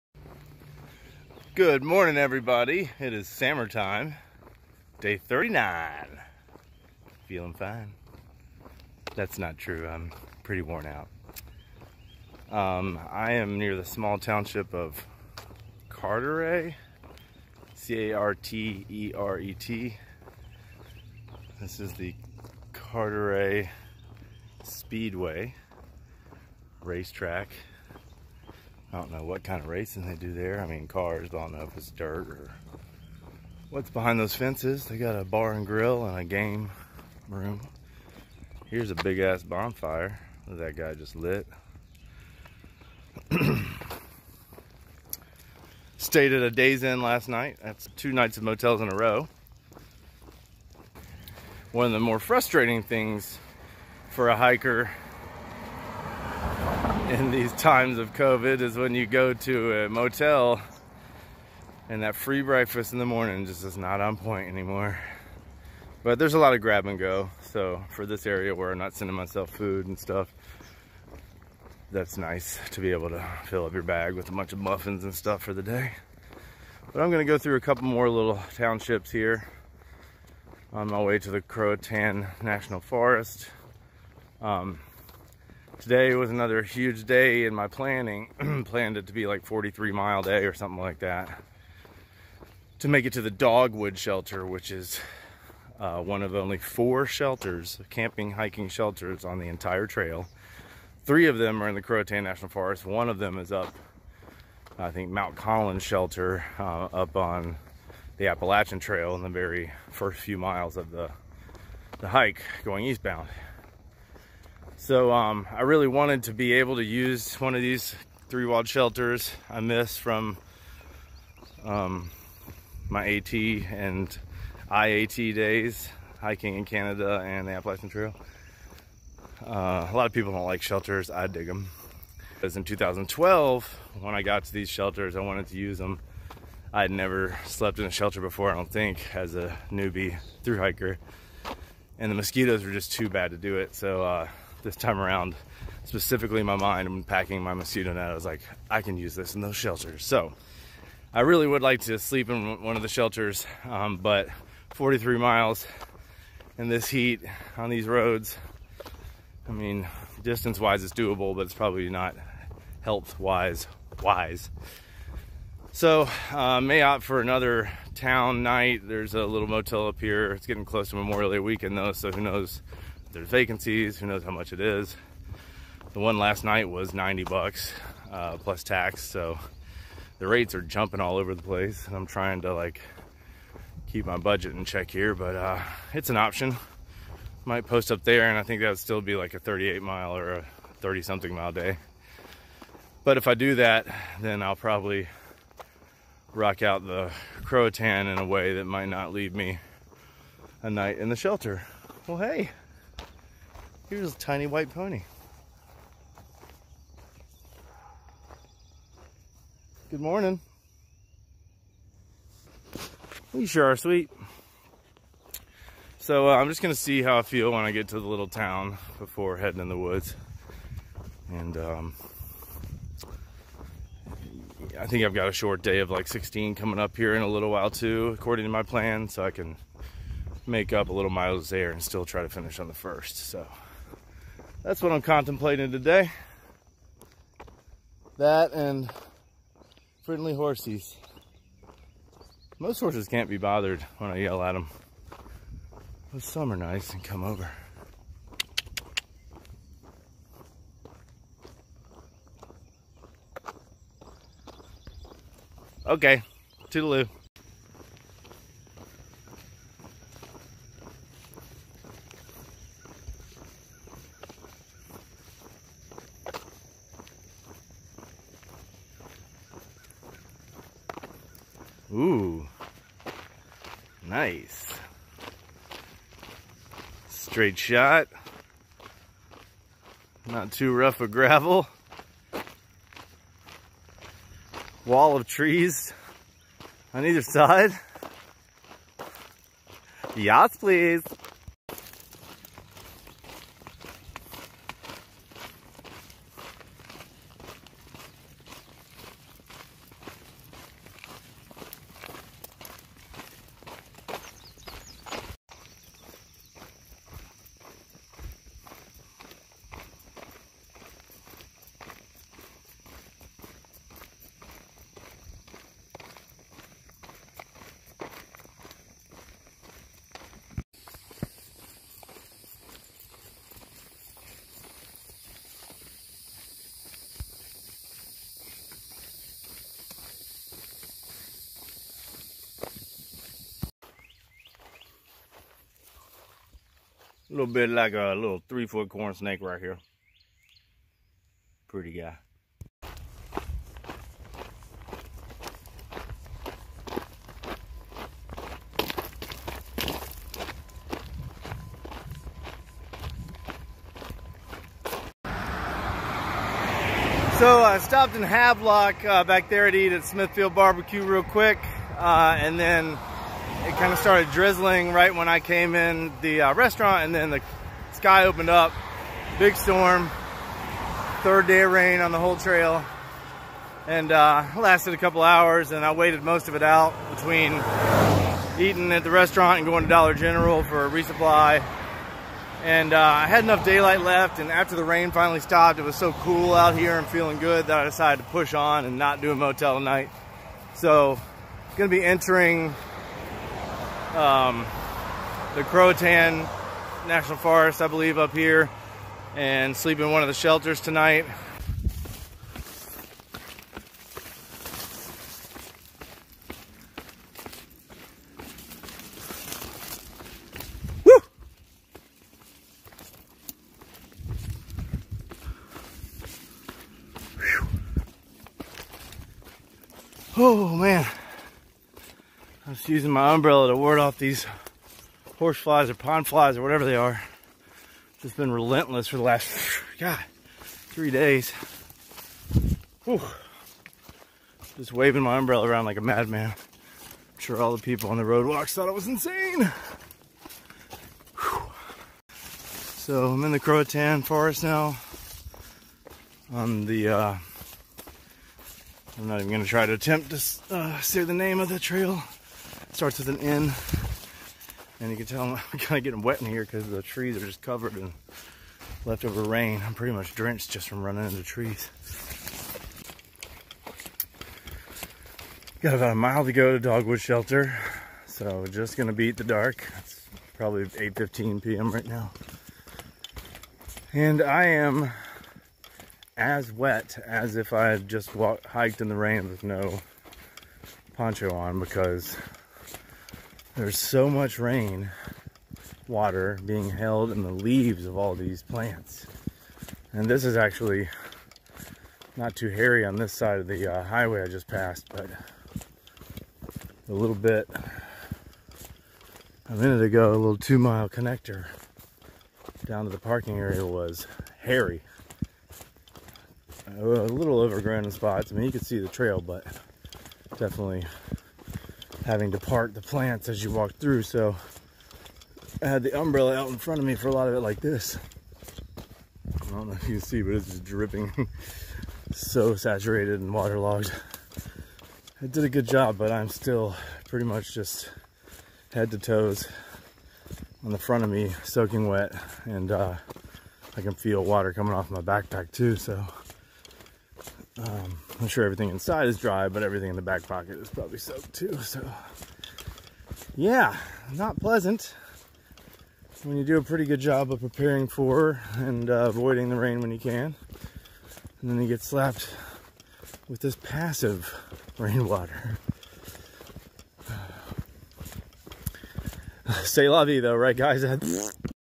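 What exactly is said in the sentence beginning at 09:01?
So, yeah, not pleasant when you do a pretty good job of preparing for and uh, avoiding the rain when you can.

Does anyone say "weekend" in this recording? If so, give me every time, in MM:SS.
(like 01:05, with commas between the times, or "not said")
02:51.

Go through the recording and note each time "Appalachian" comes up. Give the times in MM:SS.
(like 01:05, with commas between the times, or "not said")
01:48, 02:07.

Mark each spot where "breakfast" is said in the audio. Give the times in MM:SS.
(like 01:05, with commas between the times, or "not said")
01:02.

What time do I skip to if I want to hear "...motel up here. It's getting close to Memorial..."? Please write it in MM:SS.
02:49.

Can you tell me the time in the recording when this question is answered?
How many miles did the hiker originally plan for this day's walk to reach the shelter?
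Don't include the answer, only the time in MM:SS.
01:29.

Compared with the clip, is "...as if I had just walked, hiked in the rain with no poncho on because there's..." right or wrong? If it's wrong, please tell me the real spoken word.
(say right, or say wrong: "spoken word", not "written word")
right.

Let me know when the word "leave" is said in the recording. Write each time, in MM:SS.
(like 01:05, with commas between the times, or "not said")
03:19, 08:07.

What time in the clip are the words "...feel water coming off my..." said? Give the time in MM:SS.
08:54.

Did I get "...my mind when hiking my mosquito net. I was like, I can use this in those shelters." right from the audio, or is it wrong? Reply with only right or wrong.
wrong.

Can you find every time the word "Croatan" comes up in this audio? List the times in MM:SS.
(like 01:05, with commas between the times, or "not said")
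01:21, 01:41, 03:17, 06:35, 07:23.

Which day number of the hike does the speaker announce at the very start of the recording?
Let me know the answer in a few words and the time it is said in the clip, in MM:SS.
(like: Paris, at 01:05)
39, at 00:05.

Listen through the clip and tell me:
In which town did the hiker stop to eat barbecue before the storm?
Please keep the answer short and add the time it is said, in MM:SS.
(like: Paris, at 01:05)
Havelock, at 05:58.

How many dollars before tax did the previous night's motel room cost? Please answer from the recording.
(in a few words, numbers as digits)
90.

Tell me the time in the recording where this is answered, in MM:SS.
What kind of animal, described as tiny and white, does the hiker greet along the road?
03:24.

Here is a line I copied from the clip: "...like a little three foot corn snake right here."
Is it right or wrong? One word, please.
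right.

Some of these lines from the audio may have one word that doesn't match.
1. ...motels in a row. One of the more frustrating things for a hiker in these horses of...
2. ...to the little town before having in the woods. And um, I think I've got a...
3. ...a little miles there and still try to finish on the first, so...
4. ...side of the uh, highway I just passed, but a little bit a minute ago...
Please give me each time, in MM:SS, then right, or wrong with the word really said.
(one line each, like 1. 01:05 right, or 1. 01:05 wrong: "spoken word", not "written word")
1. 00:48 wrong: "times", not "horses"
2. 03:37 wrong: "heading", not "having"
3. 03:50 right
4. 08:13 right.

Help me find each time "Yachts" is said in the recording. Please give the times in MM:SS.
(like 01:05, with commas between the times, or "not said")
04:50.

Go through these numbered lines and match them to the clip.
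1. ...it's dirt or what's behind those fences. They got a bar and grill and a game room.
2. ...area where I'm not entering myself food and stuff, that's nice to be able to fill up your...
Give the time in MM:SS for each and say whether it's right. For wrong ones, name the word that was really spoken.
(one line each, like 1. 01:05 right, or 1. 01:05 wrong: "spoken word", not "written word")
1. 00:31 right
2. 01:08 wrong: "sending", not "entering".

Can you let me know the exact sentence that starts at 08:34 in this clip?
So I had the umbrella out in front of me for a lot of it like this.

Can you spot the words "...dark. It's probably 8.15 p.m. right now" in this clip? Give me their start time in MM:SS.
07:49.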